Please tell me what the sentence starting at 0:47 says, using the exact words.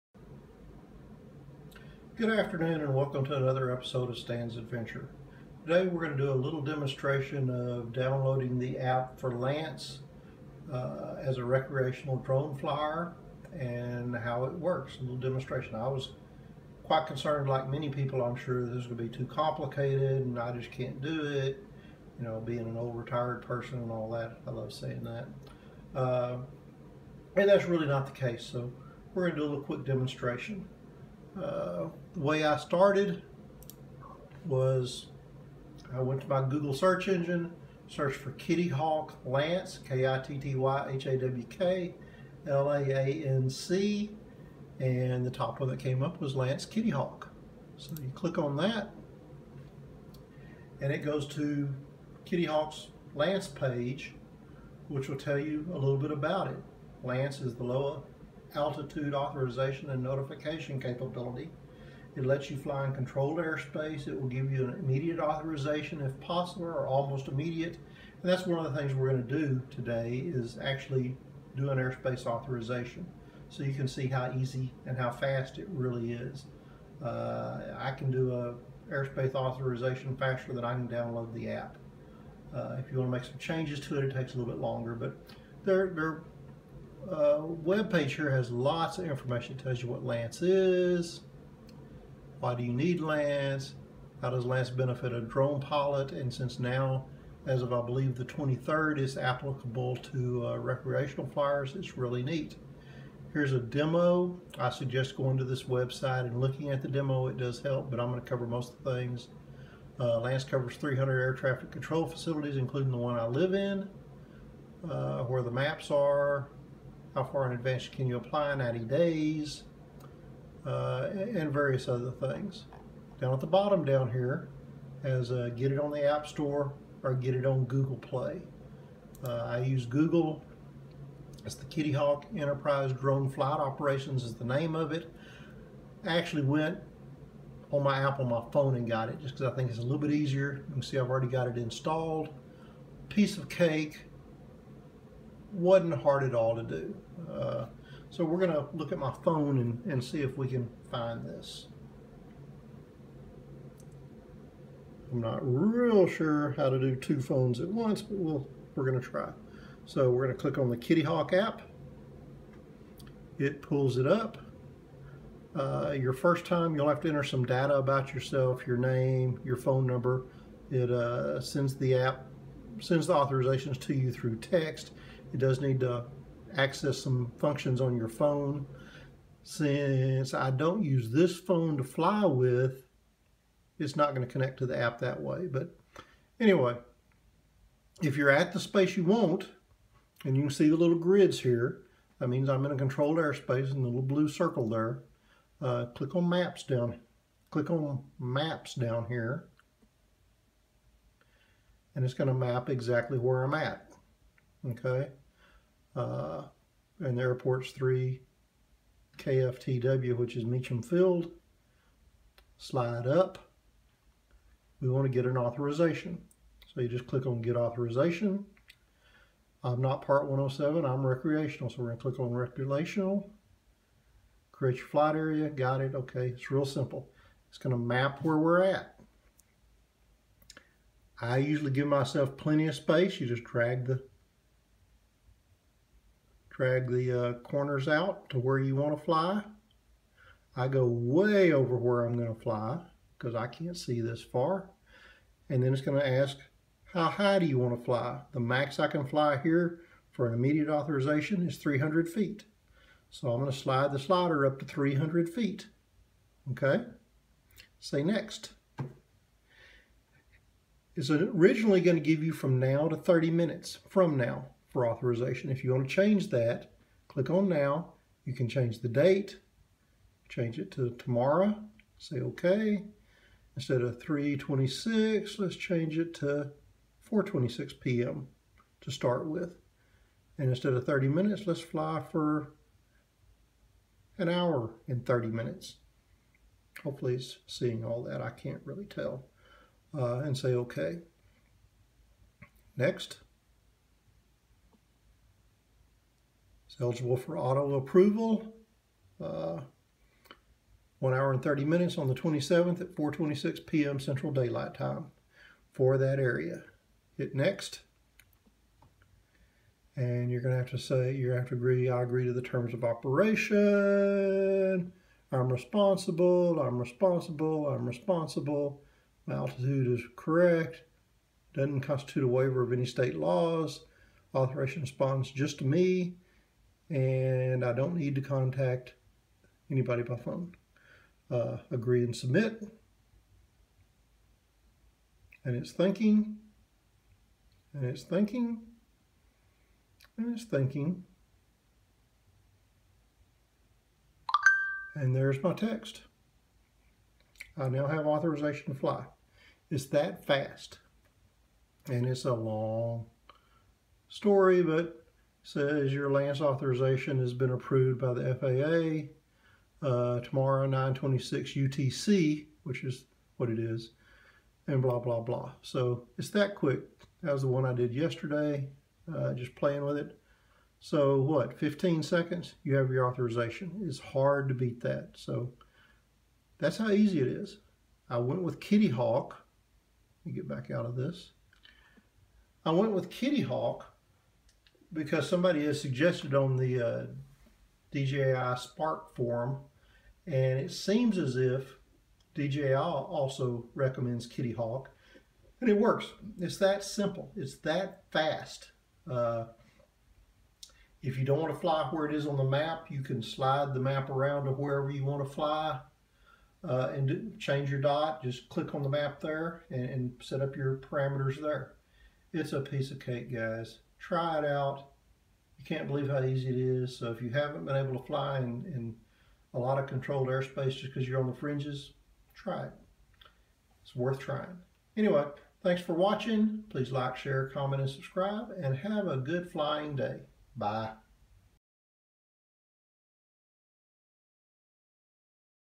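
So you click on that, and it goes to Kitty Hawk's LAANC page, which will tell you a little bit about it.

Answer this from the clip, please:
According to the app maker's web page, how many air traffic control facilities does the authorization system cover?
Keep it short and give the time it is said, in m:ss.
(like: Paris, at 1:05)
300, at 1:50.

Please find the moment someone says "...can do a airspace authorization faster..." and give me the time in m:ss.
1:17.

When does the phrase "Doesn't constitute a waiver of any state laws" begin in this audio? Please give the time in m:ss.
5:21.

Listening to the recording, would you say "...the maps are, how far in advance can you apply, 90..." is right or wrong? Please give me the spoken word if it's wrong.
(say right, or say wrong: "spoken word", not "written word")
right.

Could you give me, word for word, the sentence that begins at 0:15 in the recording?
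I was quite concerned, like many people I'm sure, this is going to be too complicated and I just can't do it.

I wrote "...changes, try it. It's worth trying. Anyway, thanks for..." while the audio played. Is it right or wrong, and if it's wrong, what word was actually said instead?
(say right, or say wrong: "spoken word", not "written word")
wrong: "fringes", not "changes".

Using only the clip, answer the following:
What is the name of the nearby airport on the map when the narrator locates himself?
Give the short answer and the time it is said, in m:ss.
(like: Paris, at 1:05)
Meacham Field, at 3:30.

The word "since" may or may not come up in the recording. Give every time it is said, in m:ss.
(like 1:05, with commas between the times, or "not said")
1:36, 2:59.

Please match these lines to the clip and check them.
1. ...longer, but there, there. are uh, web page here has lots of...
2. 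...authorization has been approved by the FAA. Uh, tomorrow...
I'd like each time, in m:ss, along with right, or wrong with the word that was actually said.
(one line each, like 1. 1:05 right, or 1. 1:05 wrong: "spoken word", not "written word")
1. 1:24 right
2. 5:56 right.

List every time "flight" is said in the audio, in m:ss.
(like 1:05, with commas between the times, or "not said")
2:13, 3:44.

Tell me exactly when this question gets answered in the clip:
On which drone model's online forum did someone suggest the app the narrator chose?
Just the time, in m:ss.
6:27.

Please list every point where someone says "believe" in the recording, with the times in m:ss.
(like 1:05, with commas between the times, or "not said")
1:37, 6:55.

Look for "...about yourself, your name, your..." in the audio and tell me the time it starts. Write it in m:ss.
2:47.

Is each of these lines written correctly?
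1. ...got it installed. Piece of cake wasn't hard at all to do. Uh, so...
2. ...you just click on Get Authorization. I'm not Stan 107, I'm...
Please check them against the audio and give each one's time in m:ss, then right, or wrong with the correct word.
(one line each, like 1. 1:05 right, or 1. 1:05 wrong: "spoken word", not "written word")
1. 2:21 right
2. 3:36 wrong: "Part", not "Stan".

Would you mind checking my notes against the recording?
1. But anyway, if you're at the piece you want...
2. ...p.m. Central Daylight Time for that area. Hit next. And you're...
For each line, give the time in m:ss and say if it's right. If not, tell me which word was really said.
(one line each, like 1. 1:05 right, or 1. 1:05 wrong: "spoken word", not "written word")
1. 3:05 wrong: "space", not "piece"
2. 5:03 right.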